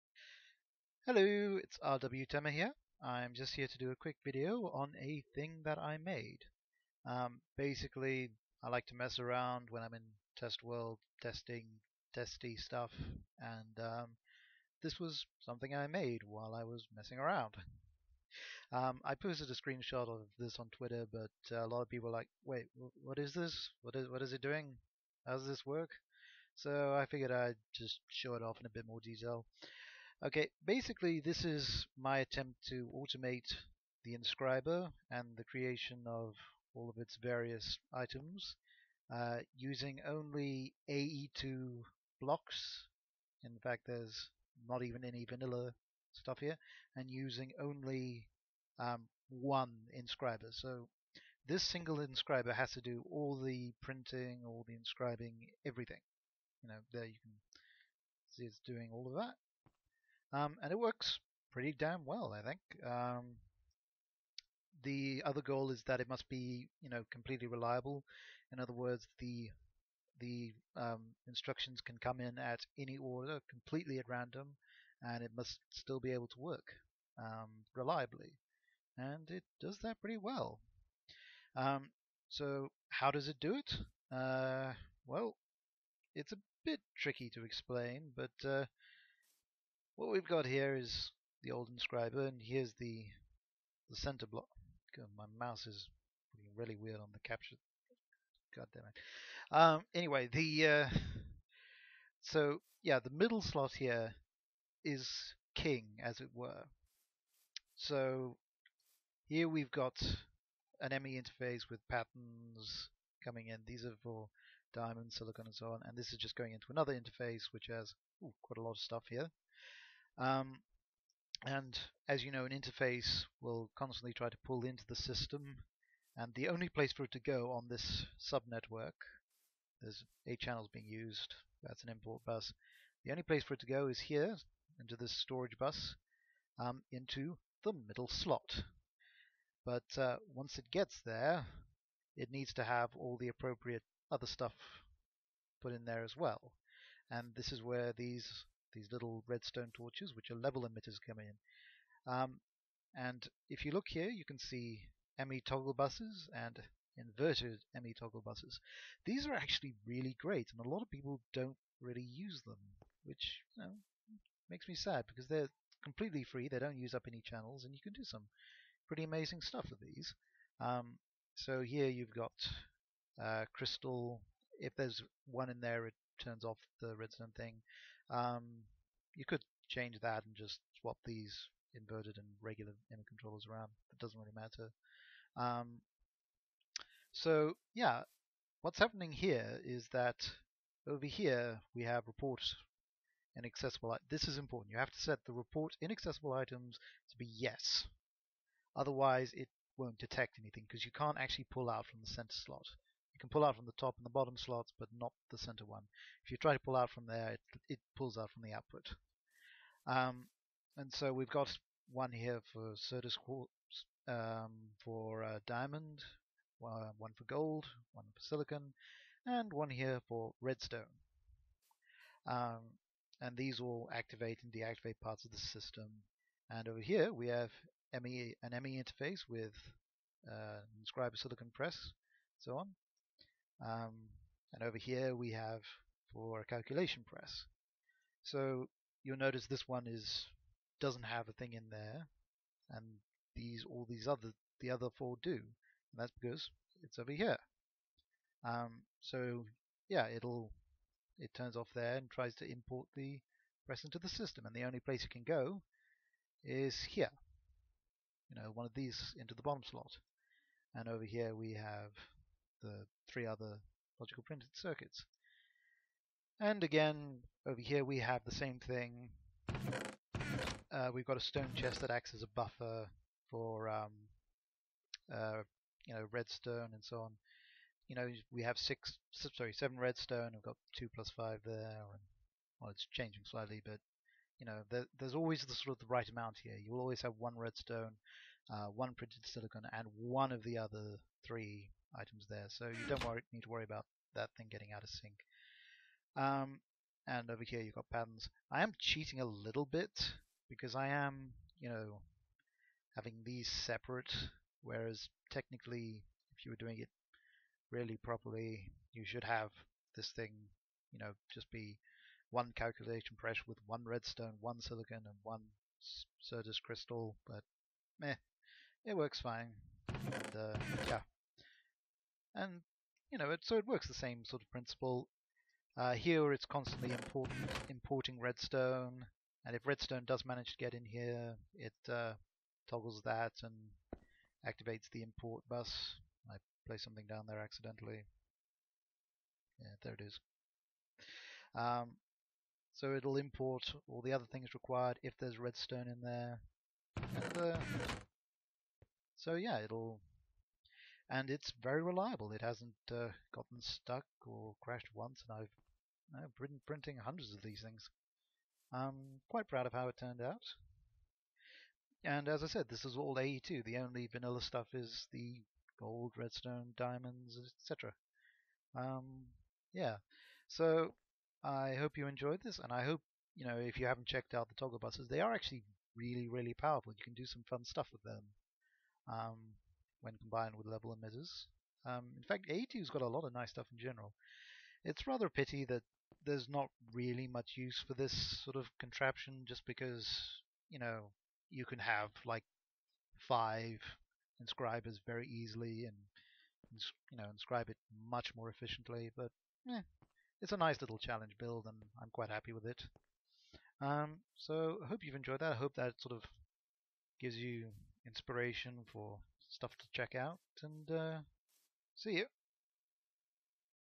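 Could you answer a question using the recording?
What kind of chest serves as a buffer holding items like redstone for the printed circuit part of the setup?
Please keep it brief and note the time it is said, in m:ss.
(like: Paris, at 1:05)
Stone chest, at 4:31.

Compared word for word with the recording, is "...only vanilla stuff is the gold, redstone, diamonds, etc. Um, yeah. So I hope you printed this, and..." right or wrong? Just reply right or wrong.
wrong.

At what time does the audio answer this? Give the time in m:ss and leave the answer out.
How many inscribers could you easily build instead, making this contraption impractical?
6:33.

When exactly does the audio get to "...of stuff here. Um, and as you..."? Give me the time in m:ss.
1:58.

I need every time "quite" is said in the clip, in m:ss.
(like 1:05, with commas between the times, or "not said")
1:58, 5:59, 6:42.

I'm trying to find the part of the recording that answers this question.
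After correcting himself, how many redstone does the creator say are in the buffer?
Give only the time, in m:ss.
4:39.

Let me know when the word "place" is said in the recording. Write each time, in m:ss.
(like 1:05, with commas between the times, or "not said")
2:06, 2:13, 4:14.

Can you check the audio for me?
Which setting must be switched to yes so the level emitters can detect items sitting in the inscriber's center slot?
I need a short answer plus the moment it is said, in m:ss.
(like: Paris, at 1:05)
Report inaccessible items, at 3:15.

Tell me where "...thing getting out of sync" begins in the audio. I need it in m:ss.
4:54.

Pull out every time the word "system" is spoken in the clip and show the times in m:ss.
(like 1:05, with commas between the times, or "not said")
2:04, 3:45, 4:14.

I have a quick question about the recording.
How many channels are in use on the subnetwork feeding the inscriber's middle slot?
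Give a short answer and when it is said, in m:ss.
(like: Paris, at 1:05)
8, at 2:10.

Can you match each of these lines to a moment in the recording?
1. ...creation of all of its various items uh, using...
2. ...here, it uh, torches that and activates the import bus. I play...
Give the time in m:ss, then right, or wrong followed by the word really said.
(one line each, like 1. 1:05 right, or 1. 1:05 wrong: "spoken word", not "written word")
1. 0:35 right
2. 5:30 wrong: "toggles", not "torches".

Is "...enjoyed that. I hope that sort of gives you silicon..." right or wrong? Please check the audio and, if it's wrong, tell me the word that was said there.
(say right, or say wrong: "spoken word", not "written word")
wrong: "inspiration", not "silicon".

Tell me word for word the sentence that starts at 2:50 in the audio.
Um, so here you've got uh, crystal.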